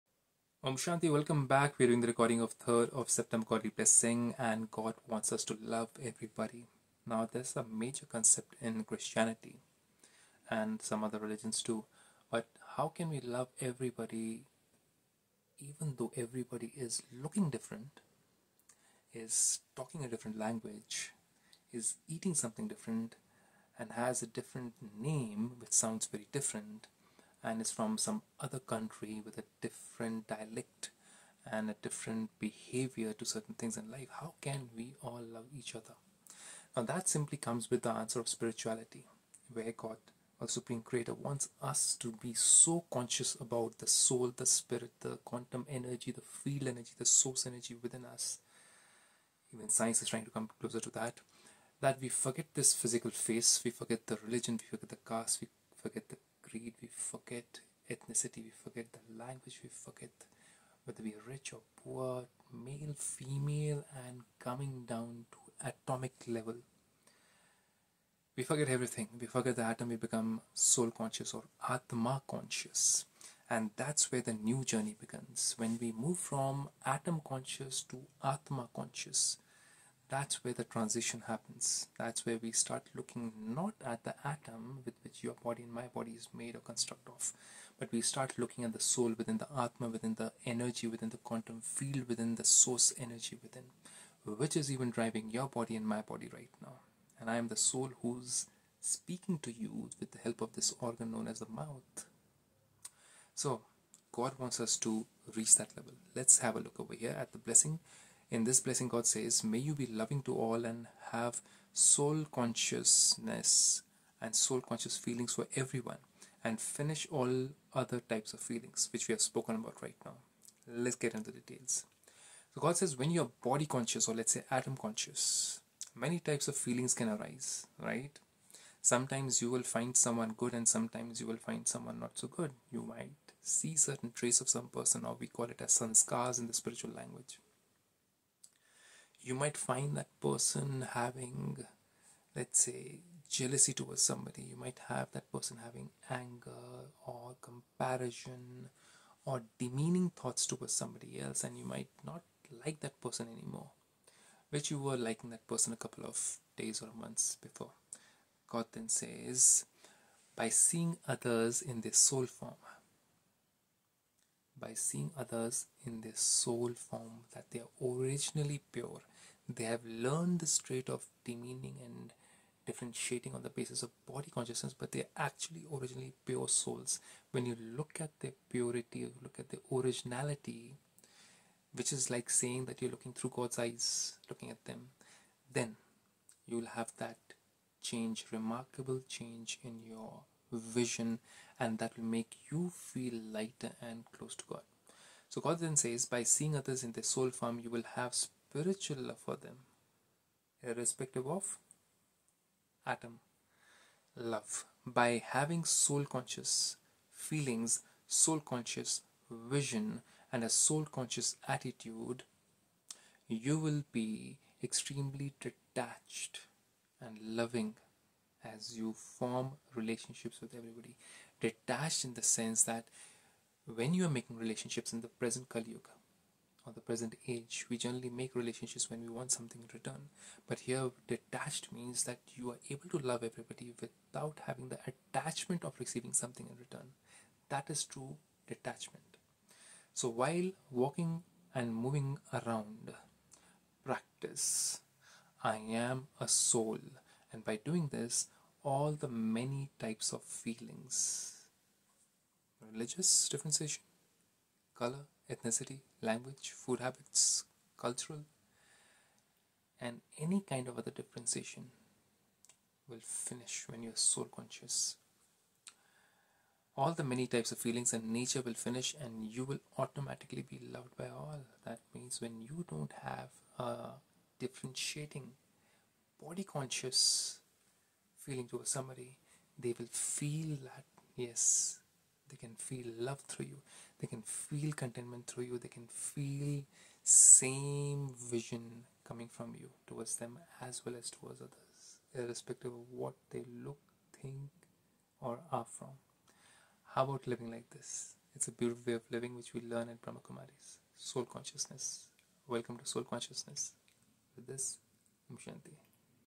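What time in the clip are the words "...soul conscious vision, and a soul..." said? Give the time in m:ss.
3:28.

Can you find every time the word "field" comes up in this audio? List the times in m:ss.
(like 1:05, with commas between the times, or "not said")
0:46, 1:31.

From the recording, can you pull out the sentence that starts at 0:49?
Even science is trying to come closer to that.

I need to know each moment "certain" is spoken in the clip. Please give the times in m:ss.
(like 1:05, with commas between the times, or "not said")
0:33, 2:13.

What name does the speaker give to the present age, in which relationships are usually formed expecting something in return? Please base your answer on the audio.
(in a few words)
Kali Yuga.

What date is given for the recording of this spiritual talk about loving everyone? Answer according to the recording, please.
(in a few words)
3rd of September.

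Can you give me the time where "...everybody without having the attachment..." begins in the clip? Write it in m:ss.
3:53.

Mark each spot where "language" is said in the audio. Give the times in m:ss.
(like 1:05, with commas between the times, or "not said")
0:20, 0:59, 2:16, 4:16.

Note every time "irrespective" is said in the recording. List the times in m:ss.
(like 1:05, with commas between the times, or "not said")
3:20, 4:52.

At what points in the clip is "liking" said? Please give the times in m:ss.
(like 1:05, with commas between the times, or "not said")
2:34.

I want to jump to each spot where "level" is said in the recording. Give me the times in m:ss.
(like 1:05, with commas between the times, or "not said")
1:06, 1:45.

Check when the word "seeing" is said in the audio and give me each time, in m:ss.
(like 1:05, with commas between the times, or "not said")
2:40, 2:44, 3:16.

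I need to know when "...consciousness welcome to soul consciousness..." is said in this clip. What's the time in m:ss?
5:01.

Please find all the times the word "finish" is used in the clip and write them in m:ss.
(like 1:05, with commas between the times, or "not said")
1:56, 4:23, 4:28.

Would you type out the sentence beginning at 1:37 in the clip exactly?
And I am the soul who's speaking to you with the help of this organ known as the mouth.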